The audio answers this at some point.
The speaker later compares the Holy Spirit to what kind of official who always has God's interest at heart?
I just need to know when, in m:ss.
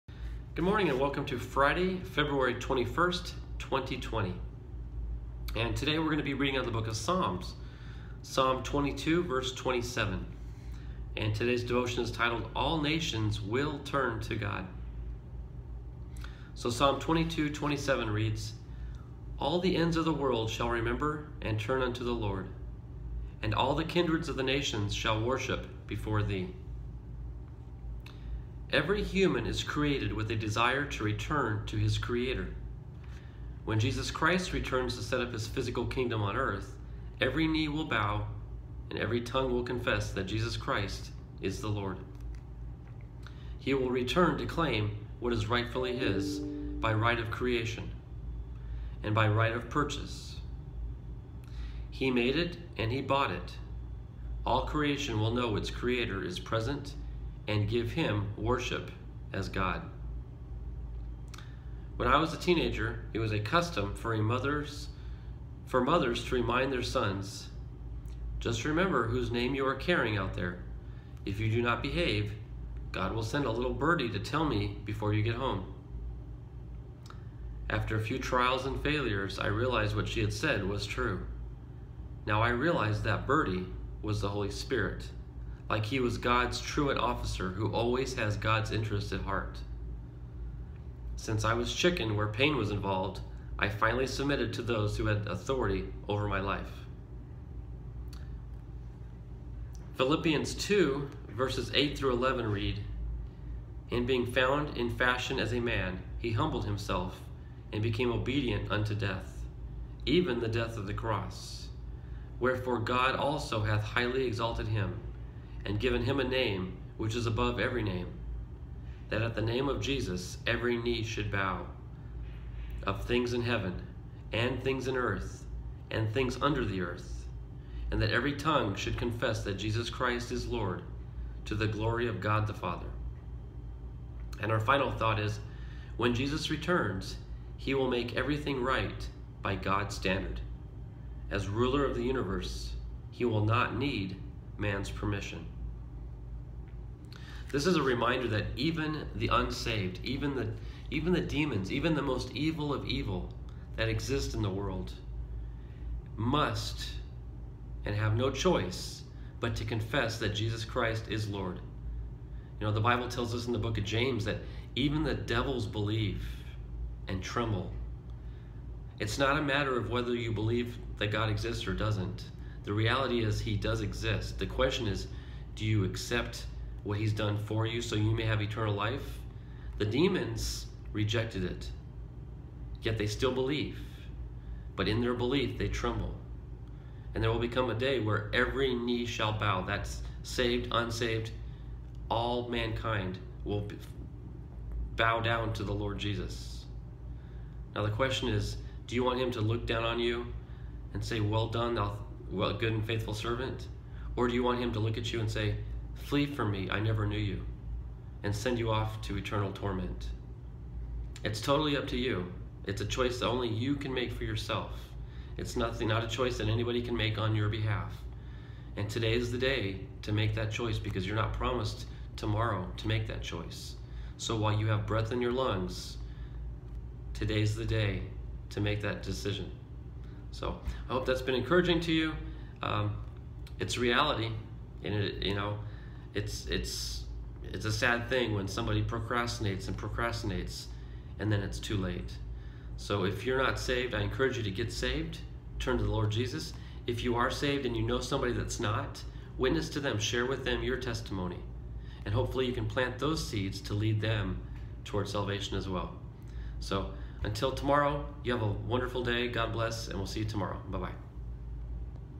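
1:26.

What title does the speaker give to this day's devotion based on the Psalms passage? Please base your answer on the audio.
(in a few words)
All Nations Will Turn to God.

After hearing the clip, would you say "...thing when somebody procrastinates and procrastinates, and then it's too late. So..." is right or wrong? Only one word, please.
right.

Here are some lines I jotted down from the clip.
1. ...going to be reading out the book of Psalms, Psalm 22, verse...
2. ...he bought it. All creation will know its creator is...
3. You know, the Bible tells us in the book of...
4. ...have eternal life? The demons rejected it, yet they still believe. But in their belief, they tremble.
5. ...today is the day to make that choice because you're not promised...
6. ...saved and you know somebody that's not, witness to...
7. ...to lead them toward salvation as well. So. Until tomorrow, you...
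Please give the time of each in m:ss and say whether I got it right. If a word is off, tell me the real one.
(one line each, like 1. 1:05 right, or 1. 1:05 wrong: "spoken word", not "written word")
1. 0:06 right
2. 0:52 right
3. 2:42 right
4. 2:58 right
5. 3:38 right
6. 4:07 right
7. 4:13 right.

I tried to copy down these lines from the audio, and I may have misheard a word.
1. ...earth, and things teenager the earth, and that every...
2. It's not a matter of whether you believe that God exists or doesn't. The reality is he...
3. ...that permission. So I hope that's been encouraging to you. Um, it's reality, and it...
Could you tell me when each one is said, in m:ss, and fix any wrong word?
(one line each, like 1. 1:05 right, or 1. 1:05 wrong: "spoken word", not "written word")
1. 2:04 wrong: "under", not "teenager"
2. 2:48 right
3. 3:48 wrong: "decision", not "permission".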